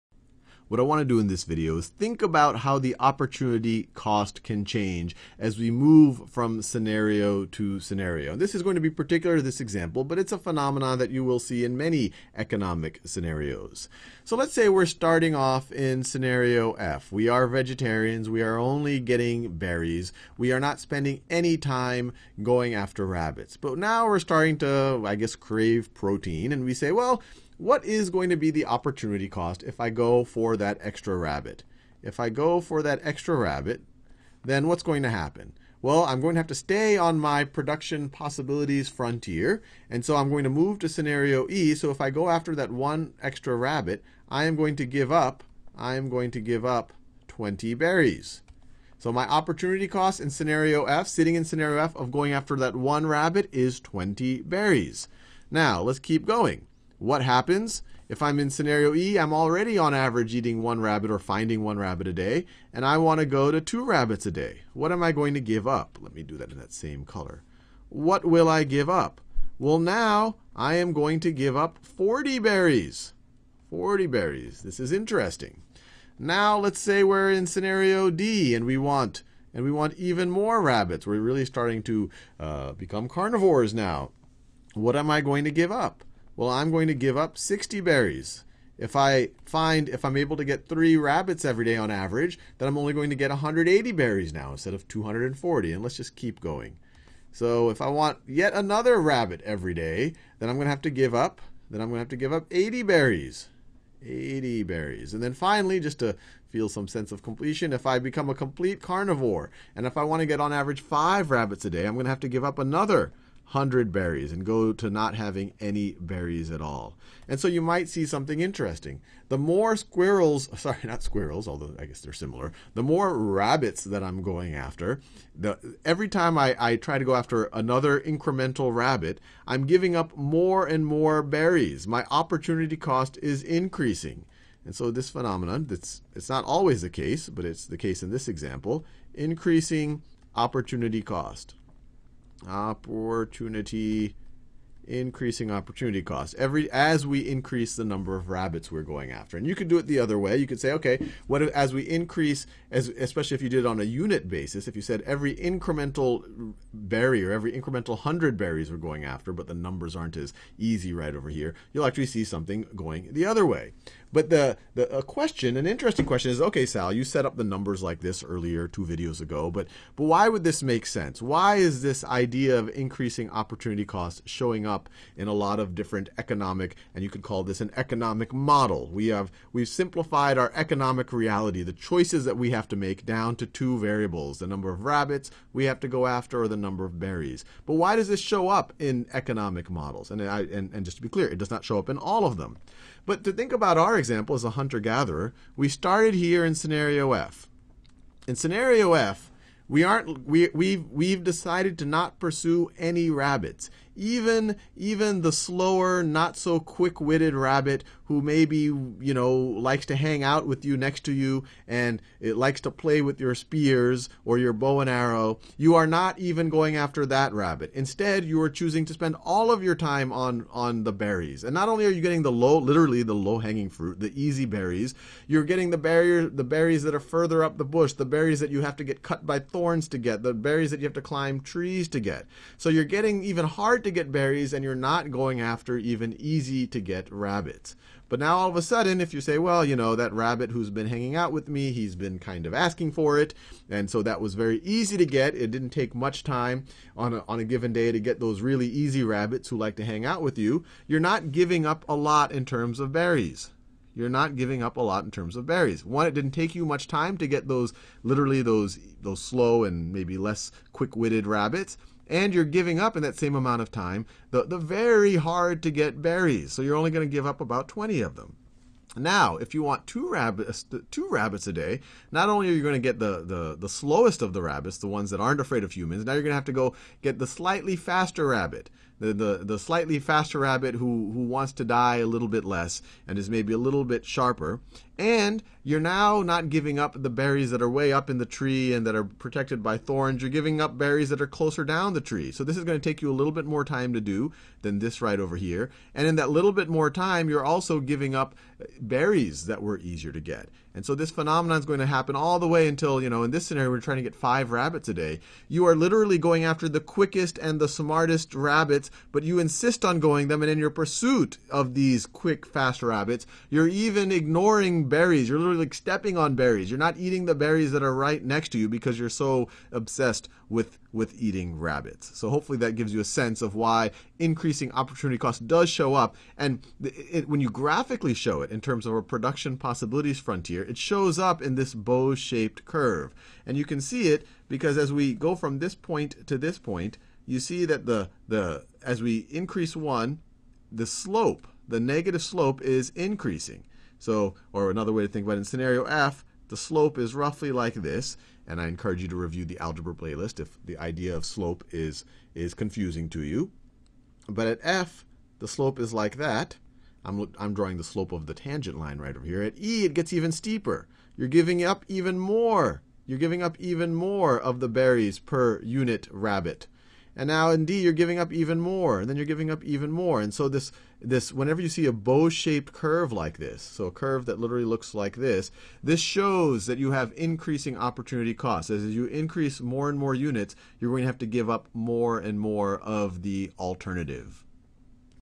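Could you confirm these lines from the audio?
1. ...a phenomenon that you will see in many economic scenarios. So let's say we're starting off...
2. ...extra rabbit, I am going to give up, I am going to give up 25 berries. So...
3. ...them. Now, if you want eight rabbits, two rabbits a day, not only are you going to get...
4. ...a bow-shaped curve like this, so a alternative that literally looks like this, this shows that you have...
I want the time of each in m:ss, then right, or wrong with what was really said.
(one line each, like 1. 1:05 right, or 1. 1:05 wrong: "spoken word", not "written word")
1. 0:10 right
2. 0:43 wrong: "20", not "25"
3. 4:28 wrong: "two", not "eight"
4. 6:11 wrong: "curve", not "alternative".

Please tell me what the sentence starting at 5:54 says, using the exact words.
But at f, the slope is like that.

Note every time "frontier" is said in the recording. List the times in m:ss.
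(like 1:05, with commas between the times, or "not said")
0:38, 5:30.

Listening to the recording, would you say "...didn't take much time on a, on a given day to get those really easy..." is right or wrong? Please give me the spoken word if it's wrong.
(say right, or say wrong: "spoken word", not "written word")
right.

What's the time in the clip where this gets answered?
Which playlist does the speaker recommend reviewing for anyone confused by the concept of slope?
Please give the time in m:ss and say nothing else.
5:49.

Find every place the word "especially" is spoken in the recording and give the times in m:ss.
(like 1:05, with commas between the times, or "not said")
2:32.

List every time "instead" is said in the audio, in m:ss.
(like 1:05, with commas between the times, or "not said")
1:34, 3:37.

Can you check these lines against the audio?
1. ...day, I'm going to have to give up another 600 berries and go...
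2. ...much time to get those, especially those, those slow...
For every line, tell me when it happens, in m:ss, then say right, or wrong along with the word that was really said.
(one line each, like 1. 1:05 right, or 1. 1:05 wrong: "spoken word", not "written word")
1. 1:51 wrong: "100", not "600"
2. 4:16 wrong: "literally", not "especially".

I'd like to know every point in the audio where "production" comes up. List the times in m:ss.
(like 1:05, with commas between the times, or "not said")
0:37, 5:29.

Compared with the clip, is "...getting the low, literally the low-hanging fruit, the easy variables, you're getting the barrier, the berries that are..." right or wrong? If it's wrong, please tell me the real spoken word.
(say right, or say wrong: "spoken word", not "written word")
wrong: "berries", not "variables".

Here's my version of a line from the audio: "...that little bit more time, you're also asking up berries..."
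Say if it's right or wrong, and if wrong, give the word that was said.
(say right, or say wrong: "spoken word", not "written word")
wrong: "giving", not "asking".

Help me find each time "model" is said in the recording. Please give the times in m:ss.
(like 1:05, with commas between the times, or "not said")
2:58, 3:09.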